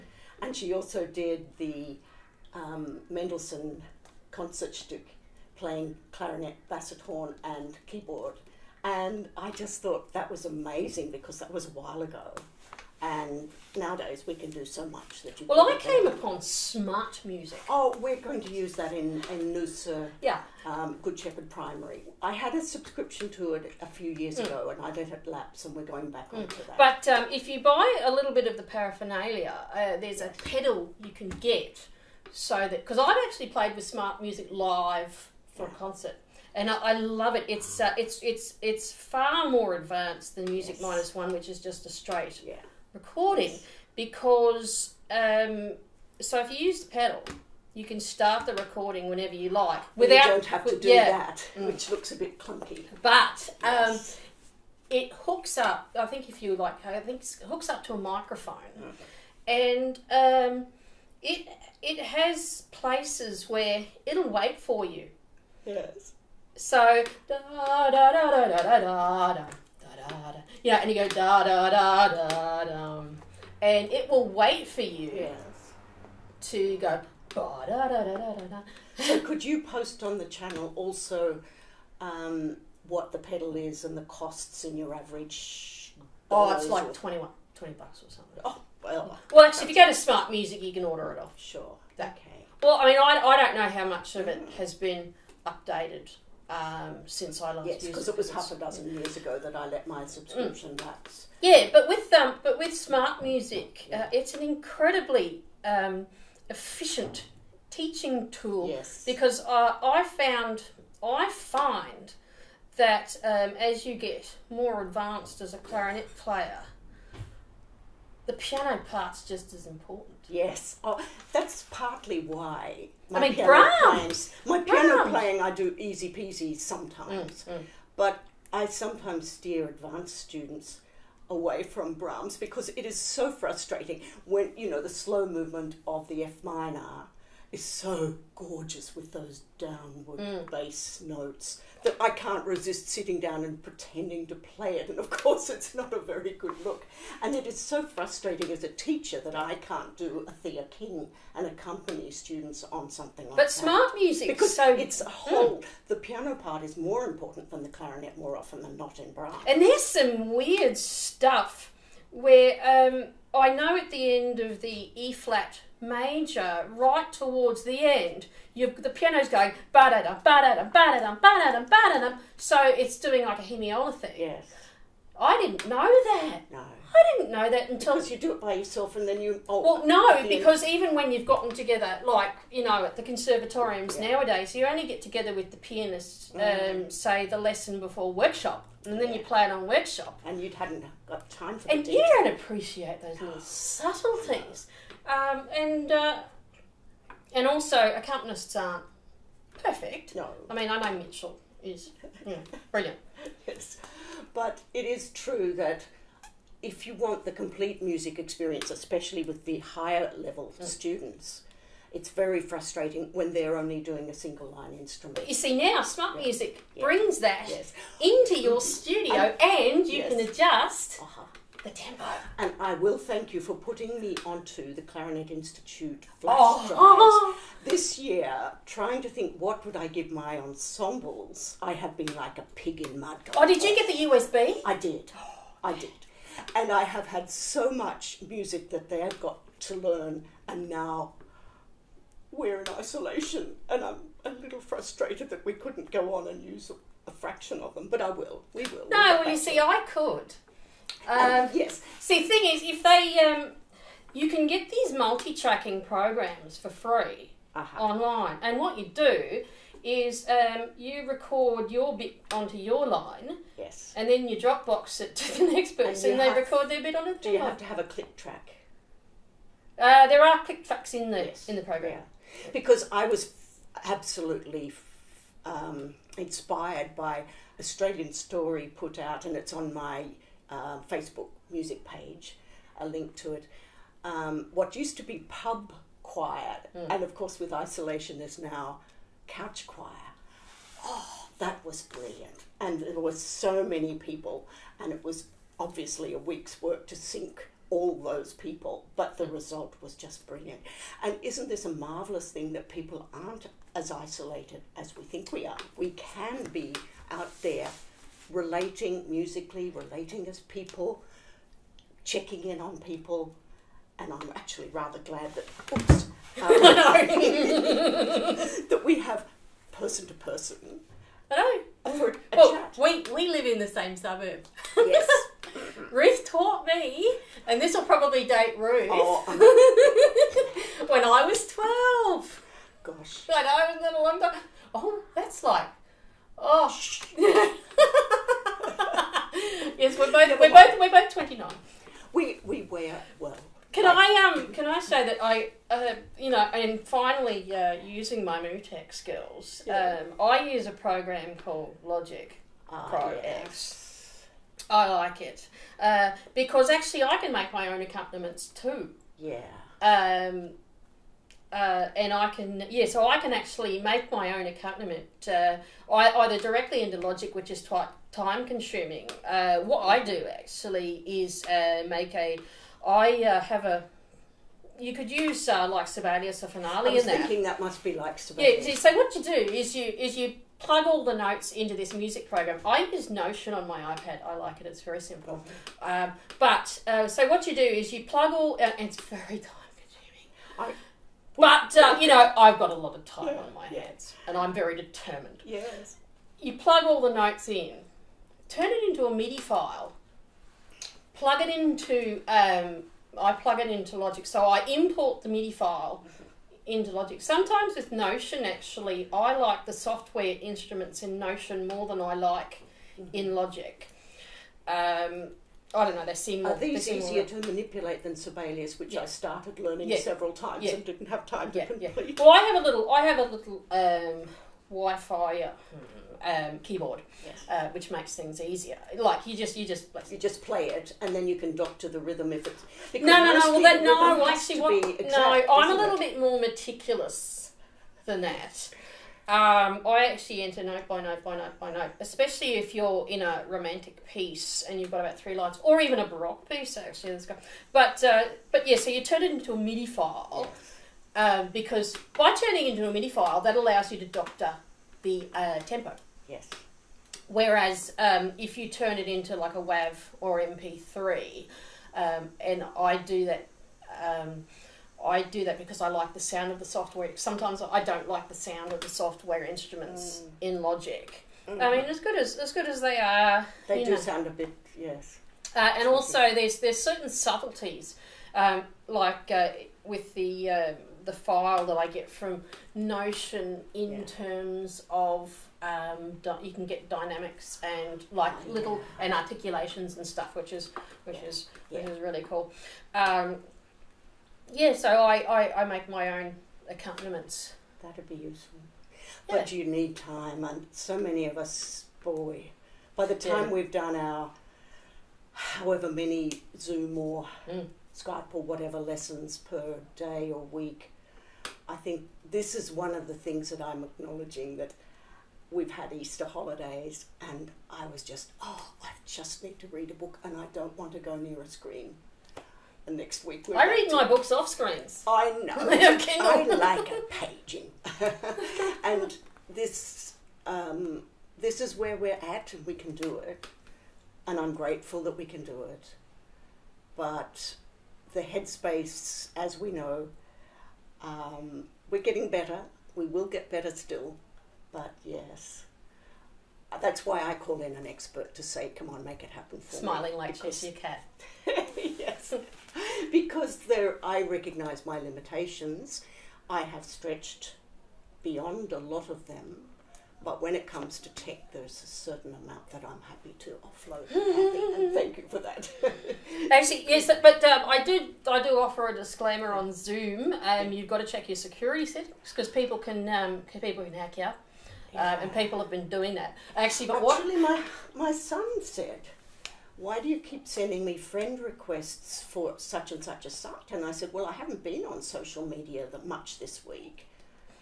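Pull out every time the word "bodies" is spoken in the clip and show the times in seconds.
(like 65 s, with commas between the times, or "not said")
not said.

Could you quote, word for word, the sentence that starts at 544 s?
But yes, uh, that's why I call in an expert to say, come on, make it happen for Smiling me.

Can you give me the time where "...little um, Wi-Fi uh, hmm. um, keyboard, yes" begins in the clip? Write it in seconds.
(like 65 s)
423 s.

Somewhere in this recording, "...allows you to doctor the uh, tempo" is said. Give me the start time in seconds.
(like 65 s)
453 s.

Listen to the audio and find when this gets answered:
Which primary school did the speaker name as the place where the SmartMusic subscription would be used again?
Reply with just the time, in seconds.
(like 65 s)
21 s.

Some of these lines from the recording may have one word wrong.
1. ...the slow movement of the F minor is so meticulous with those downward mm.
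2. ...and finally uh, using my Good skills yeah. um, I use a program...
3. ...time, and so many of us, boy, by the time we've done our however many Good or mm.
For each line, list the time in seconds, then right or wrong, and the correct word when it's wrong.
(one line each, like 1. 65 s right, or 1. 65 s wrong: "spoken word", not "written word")
1. 134 s wrong: "gorgeous", not "meticulous"
2. 346 s wrong: "Mutex", not "Good"
3. 499 s wrong: "Zoom", not "Good".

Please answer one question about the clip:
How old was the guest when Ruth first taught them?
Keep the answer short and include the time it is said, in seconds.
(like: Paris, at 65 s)
12, at 331 s.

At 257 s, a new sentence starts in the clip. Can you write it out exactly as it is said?
online, and what you do is um, you record your bit onto your line.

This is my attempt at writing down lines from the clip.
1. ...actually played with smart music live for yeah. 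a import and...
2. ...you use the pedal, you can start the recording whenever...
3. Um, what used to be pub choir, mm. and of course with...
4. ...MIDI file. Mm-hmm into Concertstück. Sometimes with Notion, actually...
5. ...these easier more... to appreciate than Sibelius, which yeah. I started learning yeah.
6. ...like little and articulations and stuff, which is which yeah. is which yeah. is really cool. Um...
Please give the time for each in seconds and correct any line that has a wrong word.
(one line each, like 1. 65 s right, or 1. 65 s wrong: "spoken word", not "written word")
1. 33 s wrong: "concert", not "import"
2. 46 s right
3. 284 s right
4. 405 s wrong: "Logic", not "Concertstück"
5. 416 s wrong: "manipulate", not "appreciate"
6. 488 s right.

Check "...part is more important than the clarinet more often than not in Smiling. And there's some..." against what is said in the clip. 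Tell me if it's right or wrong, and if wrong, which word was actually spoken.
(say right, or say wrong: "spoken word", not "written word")
wrong: "Brahms", not "Smiling".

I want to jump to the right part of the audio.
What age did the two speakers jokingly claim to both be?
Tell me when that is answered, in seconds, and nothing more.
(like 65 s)
341 s.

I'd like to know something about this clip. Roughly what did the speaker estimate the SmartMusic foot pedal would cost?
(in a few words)
$20.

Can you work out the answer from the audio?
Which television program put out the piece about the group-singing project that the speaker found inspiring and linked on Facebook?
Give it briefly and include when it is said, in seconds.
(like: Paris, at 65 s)
Australian Story, at 277 s.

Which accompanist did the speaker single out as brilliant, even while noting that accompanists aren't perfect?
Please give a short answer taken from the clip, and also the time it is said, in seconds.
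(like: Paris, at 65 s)
Mitchell, at 200 s.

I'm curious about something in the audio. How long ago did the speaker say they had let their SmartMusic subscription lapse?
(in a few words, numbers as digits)
Half a dozen years.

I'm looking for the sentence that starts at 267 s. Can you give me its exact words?
Do you have to have a click track?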